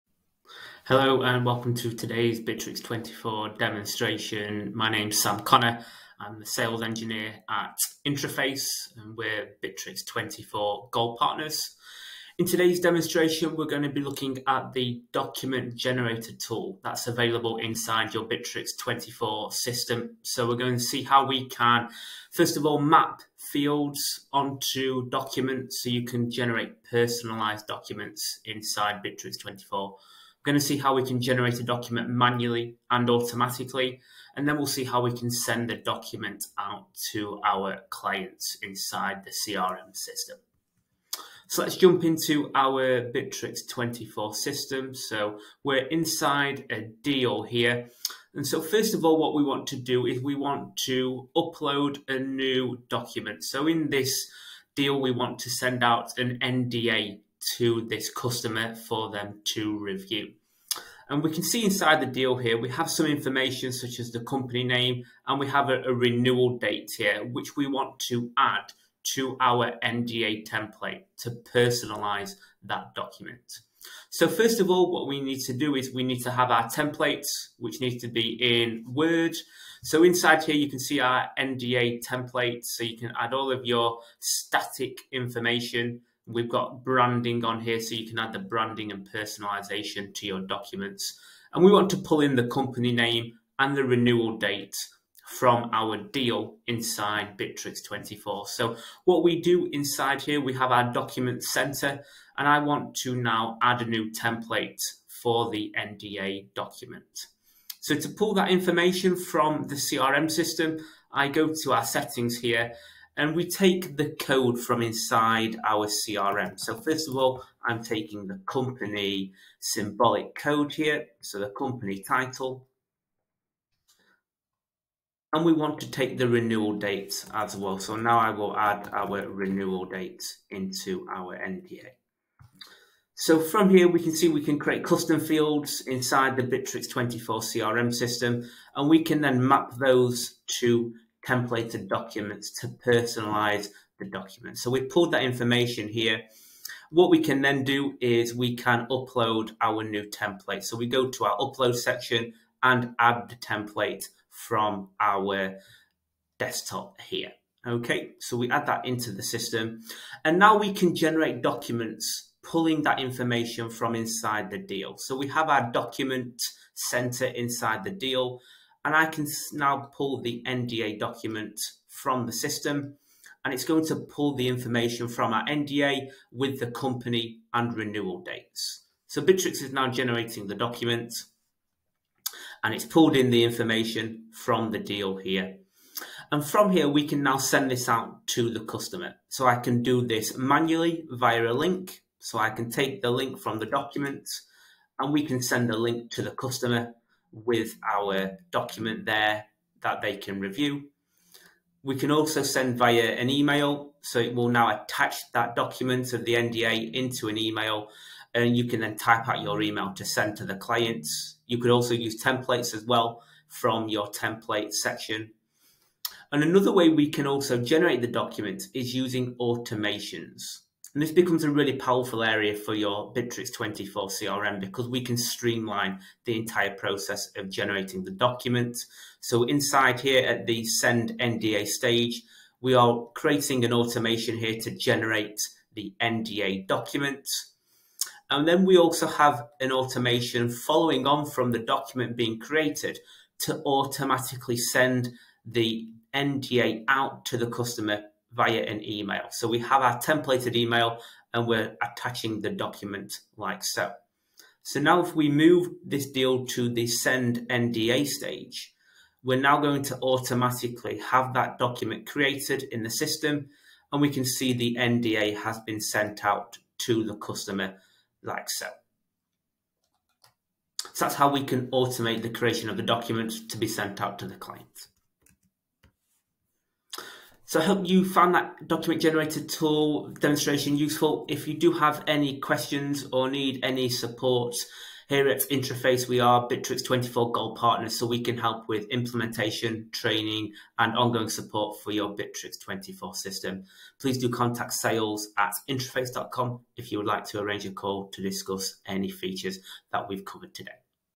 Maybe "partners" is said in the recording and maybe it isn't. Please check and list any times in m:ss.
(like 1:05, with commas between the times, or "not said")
0:11, 4:47.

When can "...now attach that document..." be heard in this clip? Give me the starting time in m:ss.
3:24.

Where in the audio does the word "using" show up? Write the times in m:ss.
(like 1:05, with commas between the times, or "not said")
3:38.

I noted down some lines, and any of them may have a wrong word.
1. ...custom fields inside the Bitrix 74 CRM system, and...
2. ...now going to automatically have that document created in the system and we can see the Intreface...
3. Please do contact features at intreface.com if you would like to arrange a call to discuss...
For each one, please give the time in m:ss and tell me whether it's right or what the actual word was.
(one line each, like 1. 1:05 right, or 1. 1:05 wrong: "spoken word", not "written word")
1. 2:14 wrong: "24", not "74"
2. 4:19 wrong: "NDA", not "Intreface"
3. 4:53 wrong: "sales", not "features".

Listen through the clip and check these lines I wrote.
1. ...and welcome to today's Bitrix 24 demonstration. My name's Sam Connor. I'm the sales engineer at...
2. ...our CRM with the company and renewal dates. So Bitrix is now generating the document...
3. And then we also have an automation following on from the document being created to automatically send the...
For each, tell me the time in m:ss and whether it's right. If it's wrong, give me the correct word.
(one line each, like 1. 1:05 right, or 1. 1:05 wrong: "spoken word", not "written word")
1. 0:01 right
2. 2:55 wrong: "NDA", not "CRM"
3. 3:58 right.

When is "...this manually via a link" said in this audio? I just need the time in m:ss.
3:10.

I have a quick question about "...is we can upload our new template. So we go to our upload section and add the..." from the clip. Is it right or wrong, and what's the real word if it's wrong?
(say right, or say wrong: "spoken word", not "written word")
right.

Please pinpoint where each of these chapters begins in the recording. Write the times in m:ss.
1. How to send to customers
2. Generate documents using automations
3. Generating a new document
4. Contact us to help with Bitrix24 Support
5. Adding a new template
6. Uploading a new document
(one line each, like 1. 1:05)
1. 3:10
2. 3:38
3. 2:45
4. 4:37
5. 1:43
6. 0:40.